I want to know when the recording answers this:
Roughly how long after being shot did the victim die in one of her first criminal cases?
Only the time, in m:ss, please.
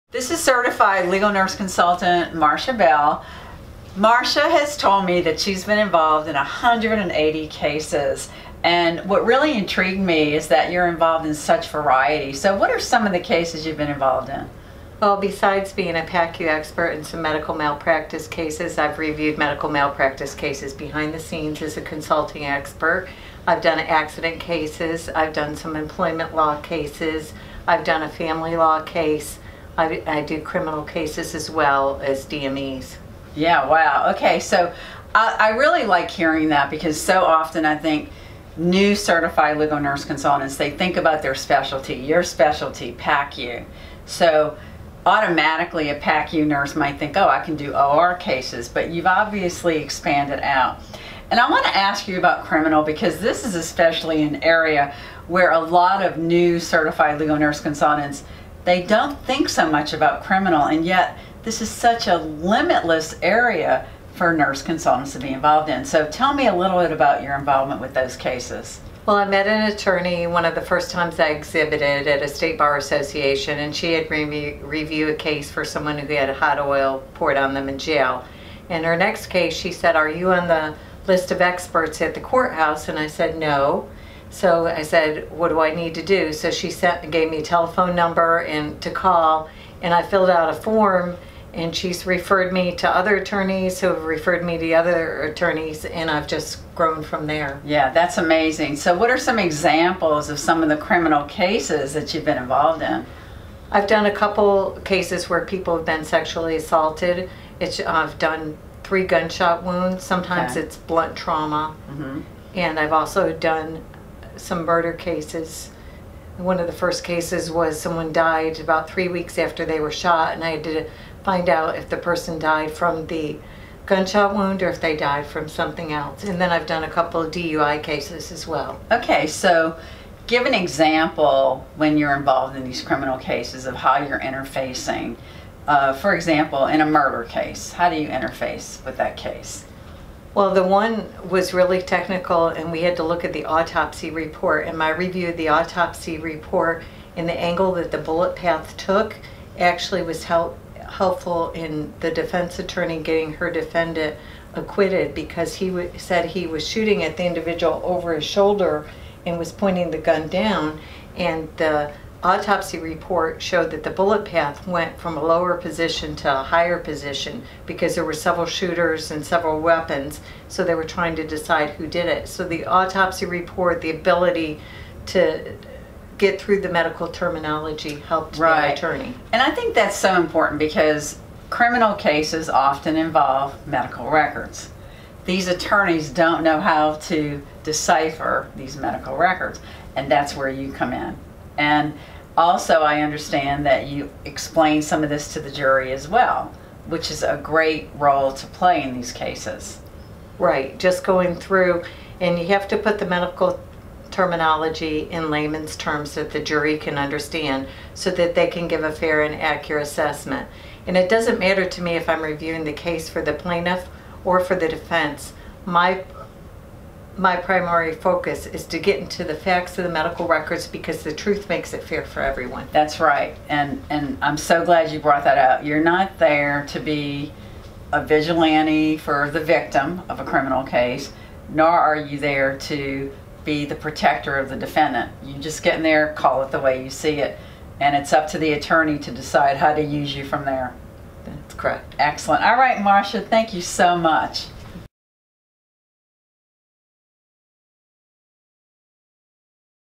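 1:58.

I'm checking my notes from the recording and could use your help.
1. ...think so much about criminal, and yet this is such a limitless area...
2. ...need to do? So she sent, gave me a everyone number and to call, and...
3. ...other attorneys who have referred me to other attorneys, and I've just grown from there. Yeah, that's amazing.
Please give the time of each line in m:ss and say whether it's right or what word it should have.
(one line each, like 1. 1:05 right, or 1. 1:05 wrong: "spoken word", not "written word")
1. 0:59 right
2. 1:25 wrong: "telephone", not "everyone"
3. 1:32 right.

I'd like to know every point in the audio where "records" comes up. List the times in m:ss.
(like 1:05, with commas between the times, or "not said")
3:04, 3:09, 3:40.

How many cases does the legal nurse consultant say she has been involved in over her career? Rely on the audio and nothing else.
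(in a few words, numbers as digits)
180.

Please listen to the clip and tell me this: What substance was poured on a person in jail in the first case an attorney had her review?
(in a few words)
Hot oil.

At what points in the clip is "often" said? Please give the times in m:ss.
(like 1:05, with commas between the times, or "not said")
0:37, 3:02.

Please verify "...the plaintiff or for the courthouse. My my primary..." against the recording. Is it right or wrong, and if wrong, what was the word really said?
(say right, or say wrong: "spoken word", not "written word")
wrong: "defense", not "courthouse".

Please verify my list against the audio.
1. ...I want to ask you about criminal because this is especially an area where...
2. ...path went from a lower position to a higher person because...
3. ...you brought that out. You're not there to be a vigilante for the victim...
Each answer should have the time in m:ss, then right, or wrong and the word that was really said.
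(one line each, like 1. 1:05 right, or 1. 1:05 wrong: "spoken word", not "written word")
1. 0:51 right
2. 2:44 wrong: "position", not "person"
3. 3:44 right.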